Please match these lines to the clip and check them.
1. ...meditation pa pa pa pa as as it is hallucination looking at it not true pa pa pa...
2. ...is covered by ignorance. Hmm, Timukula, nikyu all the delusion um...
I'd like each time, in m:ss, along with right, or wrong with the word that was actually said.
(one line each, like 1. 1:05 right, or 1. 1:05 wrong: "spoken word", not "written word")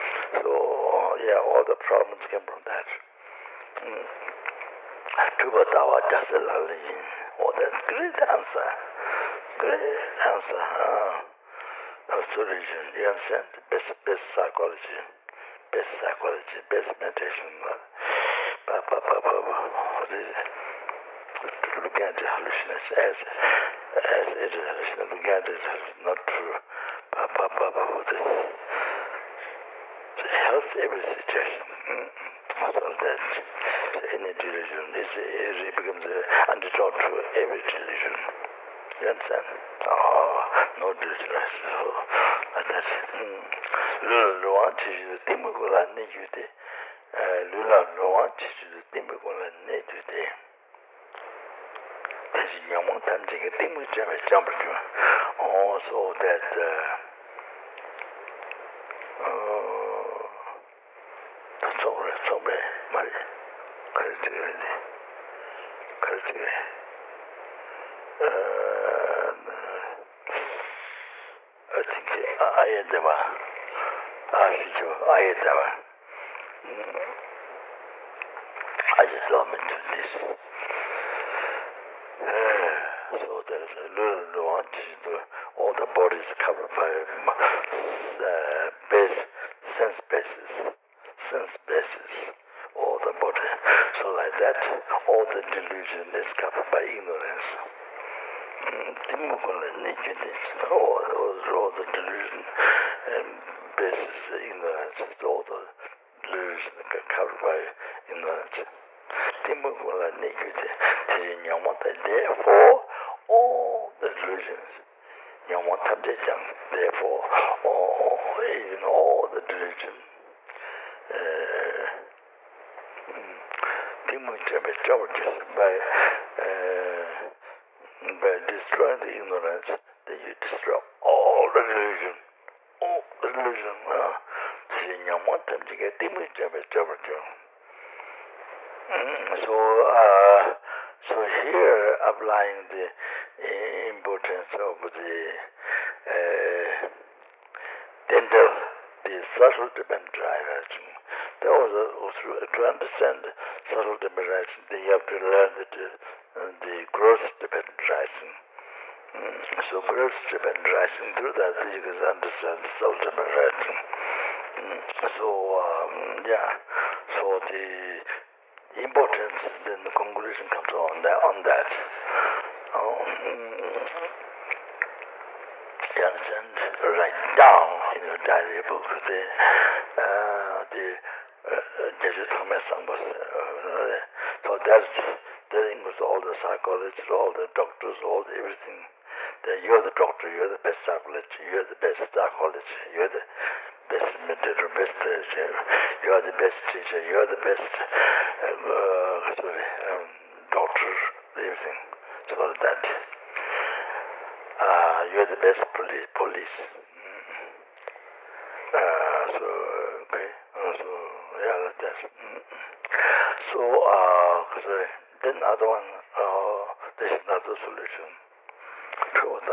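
1. 0:16 right
2. 1:36 right.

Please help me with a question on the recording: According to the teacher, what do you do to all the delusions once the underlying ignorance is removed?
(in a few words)
you destroy all.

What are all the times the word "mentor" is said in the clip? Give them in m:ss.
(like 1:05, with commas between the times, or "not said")
3:14.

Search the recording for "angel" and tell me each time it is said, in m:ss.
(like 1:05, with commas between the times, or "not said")
not said.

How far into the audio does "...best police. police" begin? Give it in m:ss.
3:25.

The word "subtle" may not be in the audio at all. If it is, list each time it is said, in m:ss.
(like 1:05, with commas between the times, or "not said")
2:29, 2:33, 2:42.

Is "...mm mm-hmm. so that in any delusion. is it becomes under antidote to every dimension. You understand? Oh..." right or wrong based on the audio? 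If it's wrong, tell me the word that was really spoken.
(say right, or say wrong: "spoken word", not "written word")
wrong: "delusion", not "dimension".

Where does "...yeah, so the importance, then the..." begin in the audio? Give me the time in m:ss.
2:46.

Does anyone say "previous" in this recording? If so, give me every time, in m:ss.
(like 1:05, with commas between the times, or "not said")
not said.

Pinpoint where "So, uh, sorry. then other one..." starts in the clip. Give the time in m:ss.
3:33.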